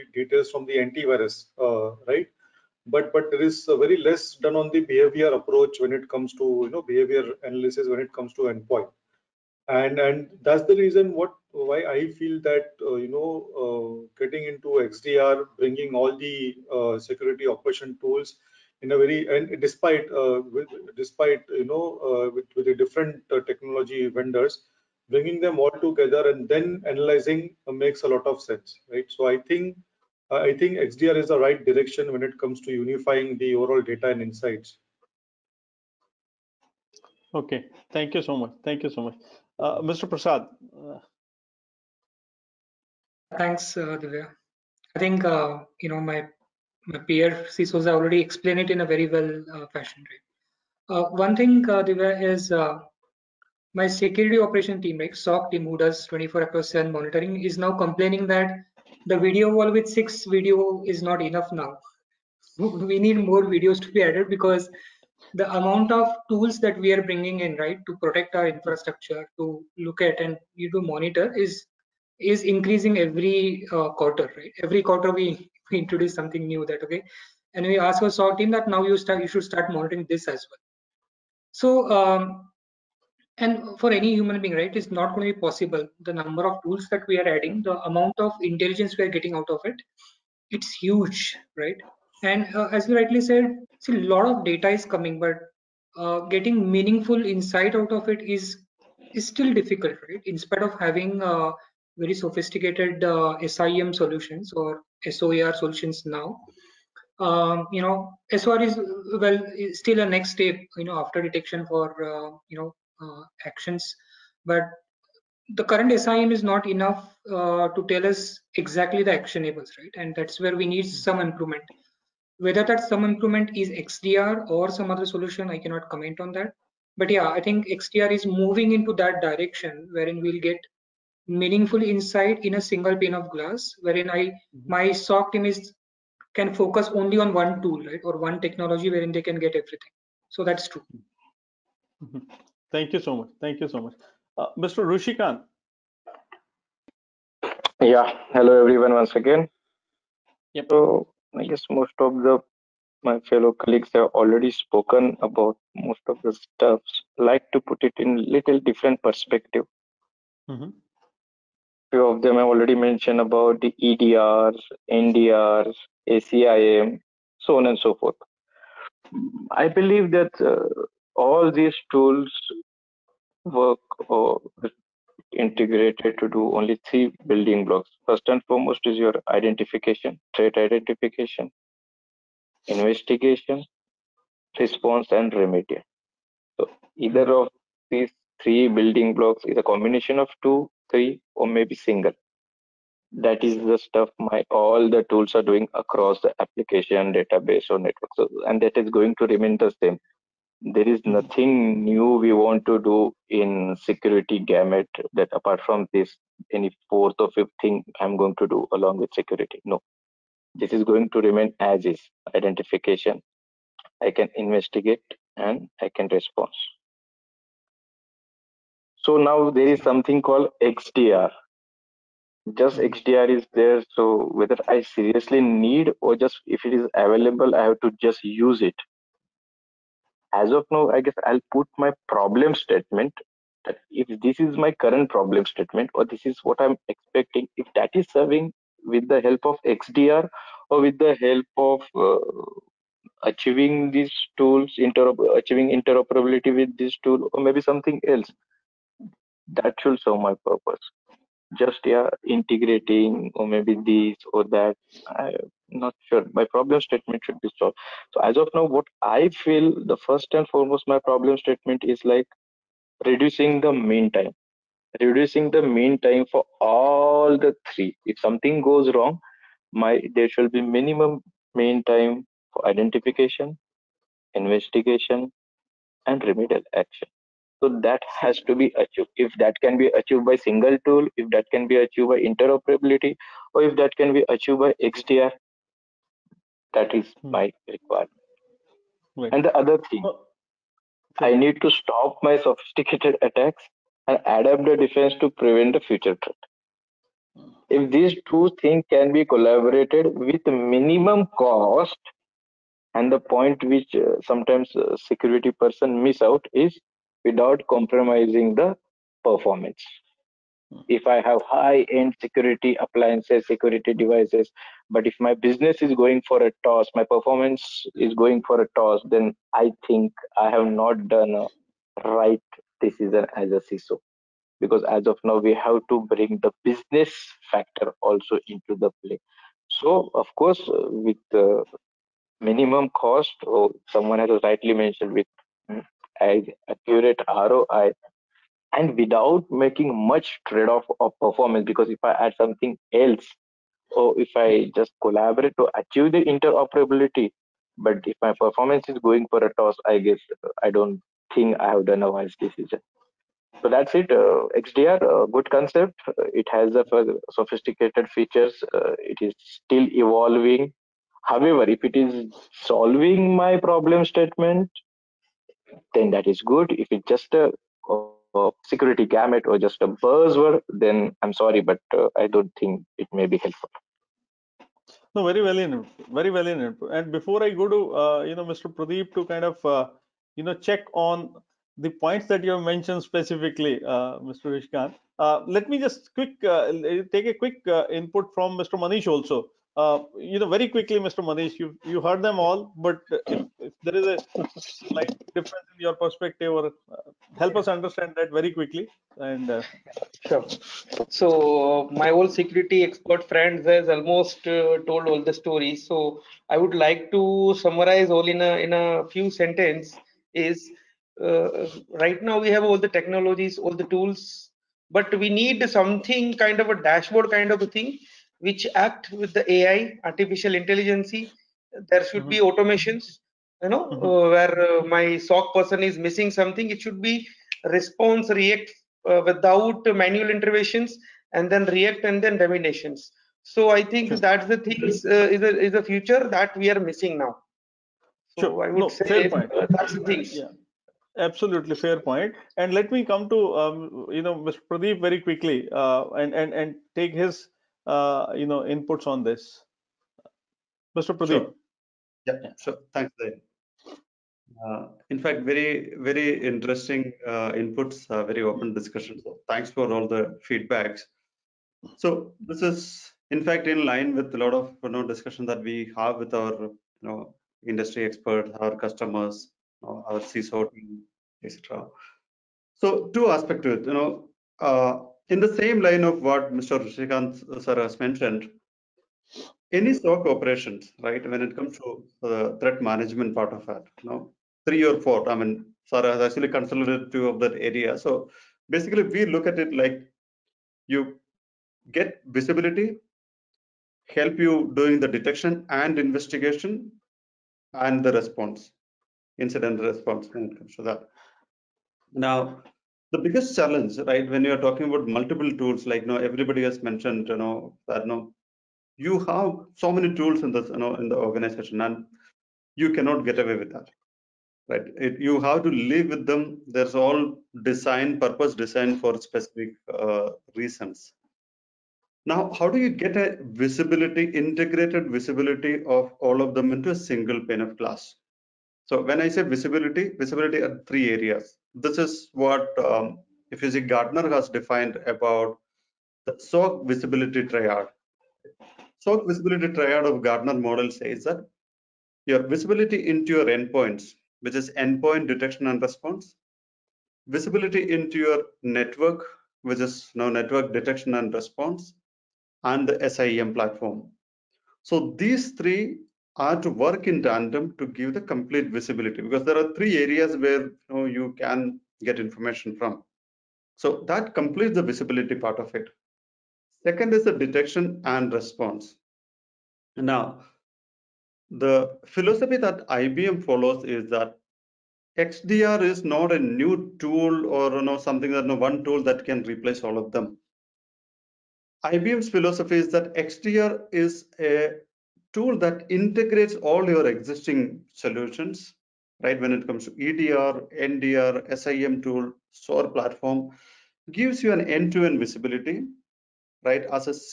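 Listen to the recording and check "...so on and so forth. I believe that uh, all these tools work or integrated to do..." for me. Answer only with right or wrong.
right.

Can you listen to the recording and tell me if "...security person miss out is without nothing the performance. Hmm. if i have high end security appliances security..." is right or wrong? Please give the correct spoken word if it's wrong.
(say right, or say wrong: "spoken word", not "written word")
wrong: "compromising", not "nothing".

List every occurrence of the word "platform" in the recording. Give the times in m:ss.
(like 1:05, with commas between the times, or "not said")
9:13, 9:52.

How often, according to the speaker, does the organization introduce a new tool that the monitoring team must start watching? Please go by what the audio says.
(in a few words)
Every quarter.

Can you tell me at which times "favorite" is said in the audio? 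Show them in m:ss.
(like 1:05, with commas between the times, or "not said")
not said.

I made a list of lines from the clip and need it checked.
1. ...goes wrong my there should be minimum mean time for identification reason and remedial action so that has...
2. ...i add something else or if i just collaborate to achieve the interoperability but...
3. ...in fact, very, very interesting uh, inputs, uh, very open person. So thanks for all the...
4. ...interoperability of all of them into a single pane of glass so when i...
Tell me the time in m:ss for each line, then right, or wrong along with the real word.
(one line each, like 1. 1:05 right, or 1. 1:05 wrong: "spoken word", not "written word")
1. 4:28 wrong: "investigation", not "reason"
2. 5:42 right
3. 7:35 wrong: "discussion", not "person"
4. 8:45 wrong: "visibility", not "interoperability".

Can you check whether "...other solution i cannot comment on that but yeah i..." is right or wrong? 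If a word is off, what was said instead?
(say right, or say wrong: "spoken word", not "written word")
right.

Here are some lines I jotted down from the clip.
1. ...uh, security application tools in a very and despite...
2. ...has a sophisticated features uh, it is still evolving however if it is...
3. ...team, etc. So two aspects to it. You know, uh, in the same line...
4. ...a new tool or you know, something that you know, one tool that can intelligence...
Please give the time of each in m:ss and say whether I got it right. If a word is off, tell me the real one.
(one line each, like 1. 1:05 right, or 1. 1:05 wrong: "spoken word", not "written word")
1. 0:16 wrong: "operation", not "application"
2. 5:56 right
3. 7:50 right
4. 9:36 wrong: "replace", not "intelligence".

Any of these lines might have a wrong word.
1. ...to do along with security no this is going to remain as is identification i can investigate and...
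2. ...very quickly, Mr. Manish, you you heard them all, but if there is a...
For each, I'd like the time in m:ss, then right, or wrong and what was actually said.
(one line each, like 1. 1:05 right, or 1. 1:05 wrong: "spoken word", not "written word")
1. 3:28 right
2. 6:30 right.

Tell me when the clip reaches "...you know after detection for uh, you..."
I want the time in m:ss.
1:50.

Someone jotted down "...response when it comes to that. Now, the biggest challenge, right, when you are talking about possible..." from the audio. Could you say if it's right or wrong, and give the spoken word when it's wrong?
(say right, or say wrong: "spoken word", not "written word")
wrong: "multiple", not "possible".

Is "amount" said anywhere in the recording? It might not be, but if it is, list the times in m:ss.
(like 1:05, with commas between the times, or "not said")
1:05, 1:27.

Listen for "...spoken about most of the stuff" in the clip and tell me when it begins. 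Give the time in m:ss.
2:34.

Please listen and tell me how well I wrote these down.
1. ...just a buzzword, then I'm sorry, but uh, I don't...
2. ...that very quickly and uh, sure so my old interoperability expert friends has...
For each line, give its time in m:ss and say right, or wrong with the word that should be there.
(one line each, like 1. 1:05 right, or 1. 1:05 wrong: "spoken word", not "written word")
1. 6:09 right
2. 6:38 wrong: "security", not "interoperability".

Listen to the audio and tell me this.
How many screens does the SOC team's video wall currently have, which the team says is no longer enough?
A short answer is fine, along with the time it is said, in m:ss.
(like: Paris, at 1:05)
6, at 0:59.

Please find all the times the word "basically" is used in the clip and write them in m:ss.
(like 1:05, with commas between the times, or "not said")
8:08.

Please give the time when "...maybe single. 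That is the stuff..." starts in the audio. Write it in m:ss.
3:11.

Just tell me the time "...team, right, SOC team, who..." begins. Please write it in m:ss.
0:54.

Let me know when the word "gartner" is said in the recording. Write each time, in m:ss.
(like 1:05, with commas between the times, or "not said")
8:53, 9:00.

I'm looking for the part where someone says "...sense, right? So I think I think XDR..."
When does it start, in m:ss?
0:28.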